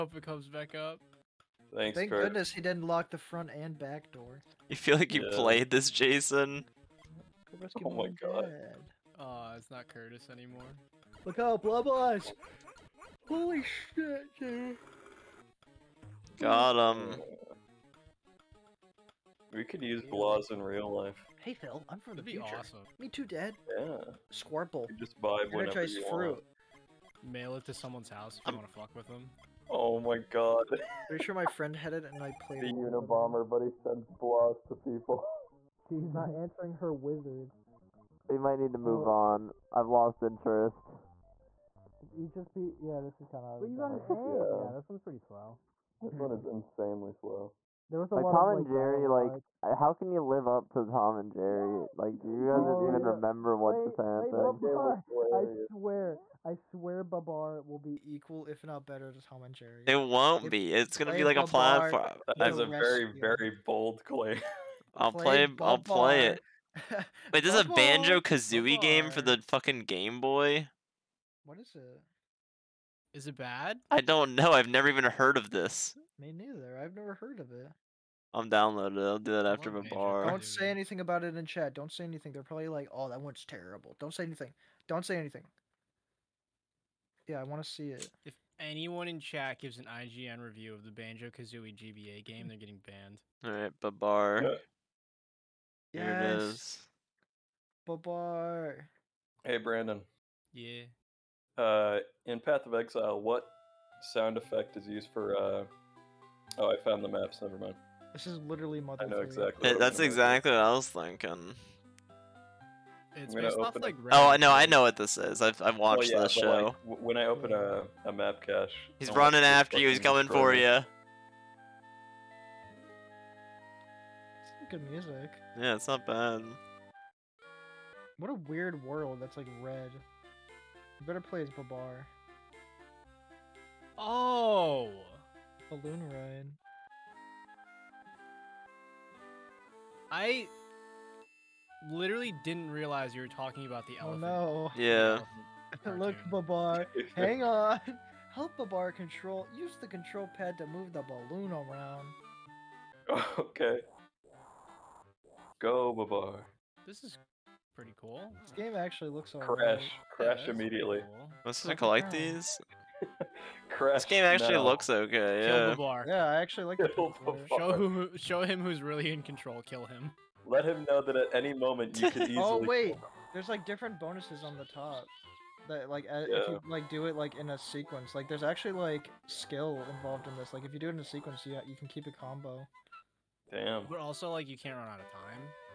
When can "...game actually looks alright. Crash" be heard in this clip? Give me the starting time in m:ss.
2:38.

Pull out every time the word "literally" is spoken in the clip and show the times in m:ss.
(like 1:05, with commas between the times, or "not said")
1:48, 2:21.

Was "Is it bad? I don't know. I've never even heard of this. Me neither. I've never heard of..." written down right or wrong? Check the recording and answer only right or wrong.
right.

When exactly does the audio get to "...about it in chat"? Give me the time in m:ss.
1:21.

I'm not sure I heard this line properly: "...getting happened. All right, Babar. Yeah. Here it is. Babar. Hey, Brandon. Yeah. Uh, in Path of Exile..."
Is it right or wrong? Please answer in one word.
wrong.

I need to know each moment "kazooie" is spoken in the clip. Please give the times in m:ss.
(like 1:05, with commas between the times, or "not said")
1:08, 1:31.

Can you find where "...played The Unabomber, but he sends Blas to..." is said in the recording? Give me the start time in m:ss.
0:32.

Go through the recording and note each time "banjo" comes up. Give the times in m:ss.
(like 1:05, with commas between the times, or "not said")
1:07, 1:30.